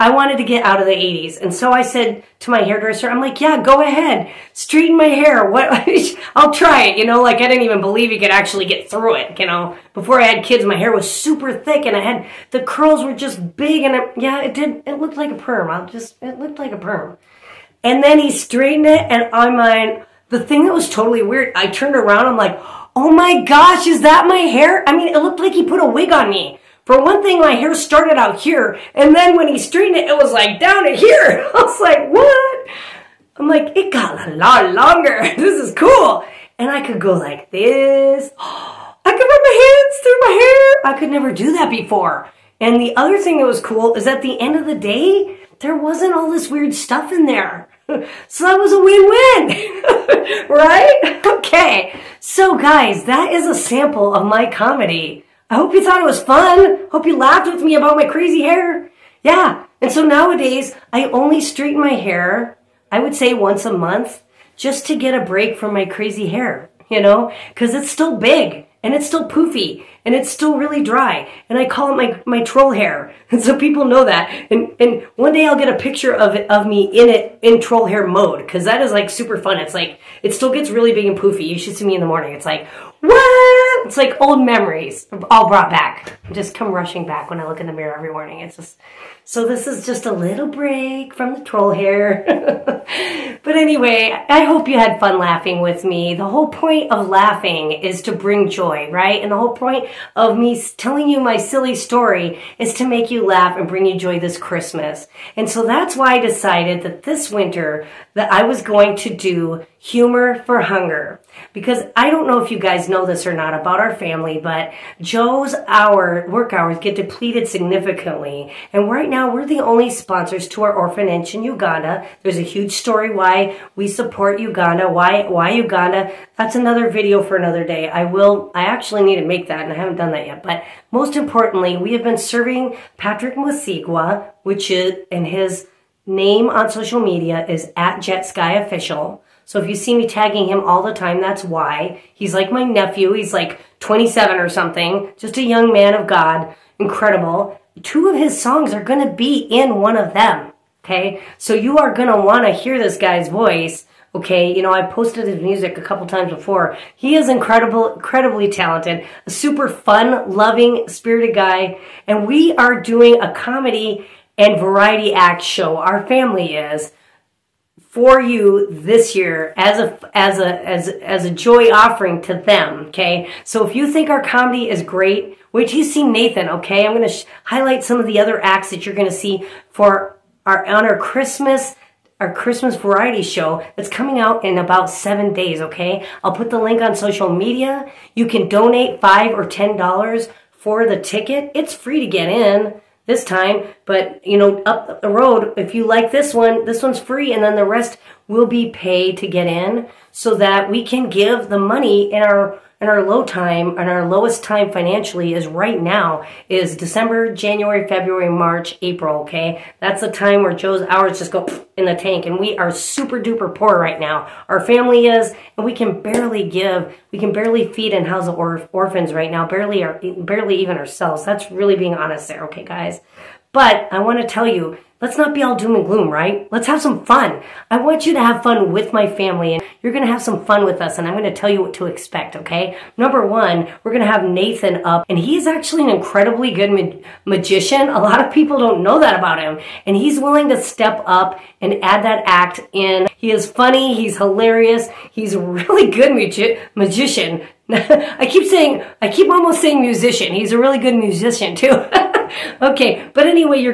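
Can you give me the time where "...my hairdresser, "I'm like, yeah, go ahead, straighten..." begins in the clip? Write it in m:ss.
0:02.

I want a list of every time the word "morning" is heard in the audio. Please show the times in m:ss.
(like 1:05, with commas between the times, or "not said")
1:22, 1:28.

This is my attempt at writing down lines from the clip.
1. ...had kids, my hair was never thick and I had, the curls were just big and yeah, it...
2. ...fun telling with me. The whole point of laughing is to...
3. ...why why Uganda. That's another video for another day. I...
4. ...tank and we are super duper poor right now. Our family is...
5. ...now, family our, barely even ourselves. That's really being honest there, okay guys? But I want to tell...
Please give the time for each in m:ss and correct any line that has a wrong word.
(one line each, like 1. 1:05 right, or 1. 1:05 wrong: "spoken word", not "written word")
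1. 0:10 wrong: "super", not "never"
2. 1:34 wrong: "laughing", not "telling"
3. 2:04 right
4. 3:31 right
5. 3:39 wrong: "barely", not "family".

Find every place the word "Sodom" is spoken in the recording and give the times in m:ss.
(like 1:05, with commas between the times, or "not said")
not said.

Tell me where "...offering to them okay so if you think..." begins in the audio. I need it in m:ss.
2:51.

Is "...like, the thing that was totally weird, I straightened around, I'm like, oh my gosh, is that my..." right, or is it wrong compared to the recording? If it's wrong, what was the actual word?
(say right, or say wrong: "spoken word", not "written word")
wrong: "turned", not "straightened".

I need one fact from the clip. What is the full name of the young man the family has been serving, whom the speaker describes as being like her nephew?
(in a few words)
Patrick Mwesigwa.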